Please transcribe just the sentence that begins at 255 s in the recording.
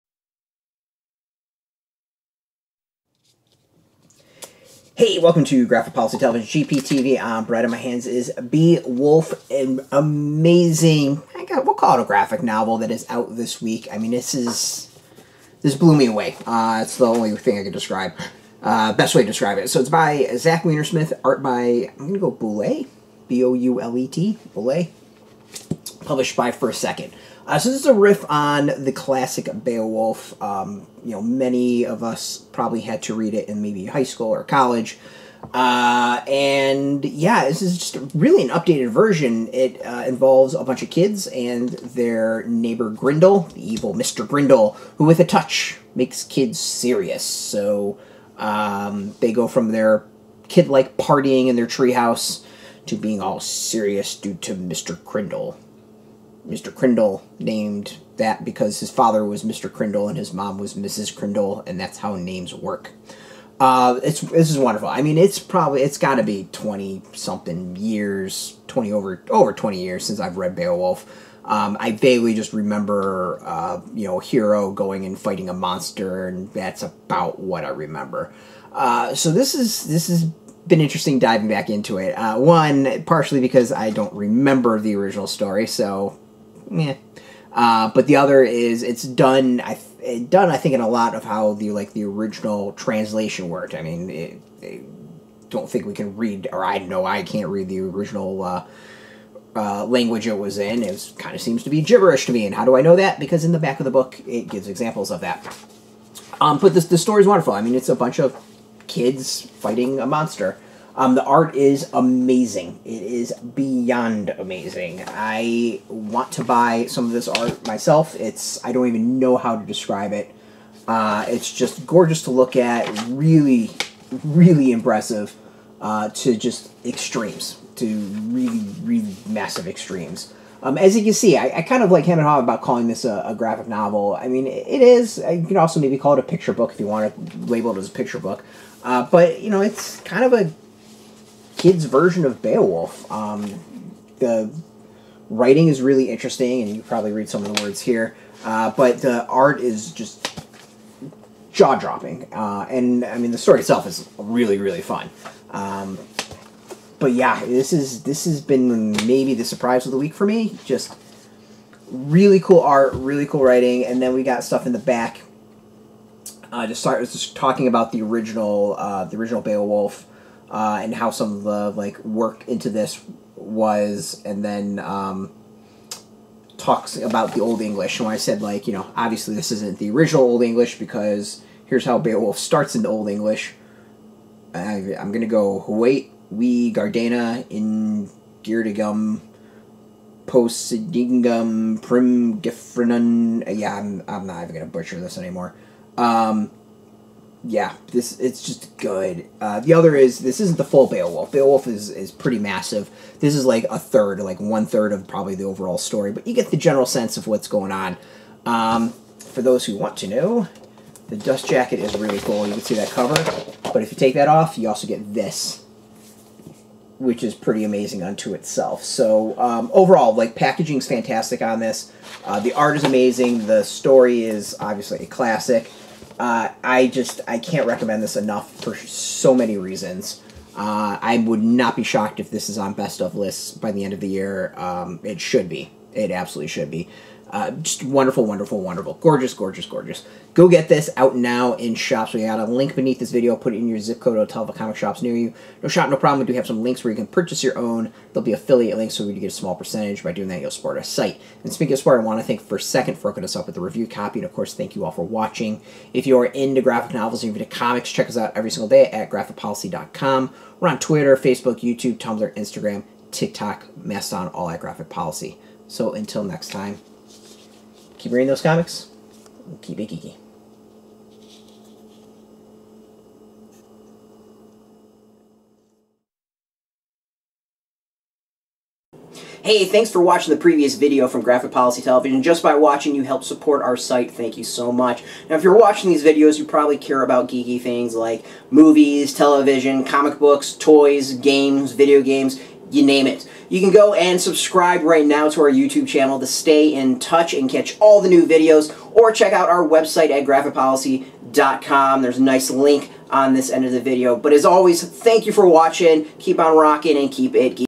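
If you are into graphic novels and into comics, check us out every single day at graphicpolicy.com.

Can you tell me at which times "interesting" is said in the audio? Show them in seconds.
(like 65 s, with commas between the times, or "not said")
80 s, 146 s.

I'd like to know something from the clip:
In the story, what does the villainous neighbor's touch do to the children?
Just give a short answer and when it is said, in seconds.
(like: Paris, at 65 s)
Makes kids serious, at 45 s.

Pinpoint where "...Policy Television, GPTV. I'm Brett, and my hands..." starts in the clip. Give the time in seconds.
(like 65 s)
5 s.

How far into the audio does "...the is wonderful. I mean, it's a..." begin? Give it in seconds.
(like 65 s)
106 s.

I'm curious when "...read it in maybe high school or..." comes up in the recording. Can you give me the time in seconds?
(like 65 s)
33 s.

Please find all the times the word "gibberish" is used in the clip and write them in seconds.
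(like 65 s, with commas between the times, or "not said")
101 s.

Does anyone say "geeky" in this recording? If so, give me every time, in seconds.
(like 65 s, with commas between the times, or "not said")
269 s, 287 s, 307 s.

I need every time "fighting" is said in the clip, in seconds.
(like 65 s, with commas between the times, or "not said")
75 s, 109 s.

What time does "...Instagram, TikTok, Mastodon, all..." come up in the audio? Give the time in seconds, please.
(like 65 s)
262 s.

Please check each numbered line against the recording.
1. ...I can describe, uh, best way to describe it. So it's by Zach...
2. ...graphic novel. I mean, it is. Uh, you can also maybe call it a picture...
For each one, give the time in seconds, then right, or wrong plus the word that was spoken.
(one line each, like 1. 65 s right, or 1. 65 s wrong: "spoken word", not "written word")
1. 17 s right
2. 133 s right.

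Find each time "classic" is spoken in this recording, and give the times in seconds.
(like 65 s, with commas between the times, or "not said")
28 s, 225 s.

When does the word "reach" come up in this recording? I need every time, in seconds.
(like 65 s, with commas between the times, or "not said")
not said.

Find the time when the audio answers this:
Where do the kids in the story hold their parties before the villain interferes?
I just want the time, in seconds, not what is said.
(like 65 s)
51 s.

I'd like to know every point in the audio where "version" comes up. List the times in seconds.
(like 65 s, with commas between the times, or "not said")
38 s, 141 s.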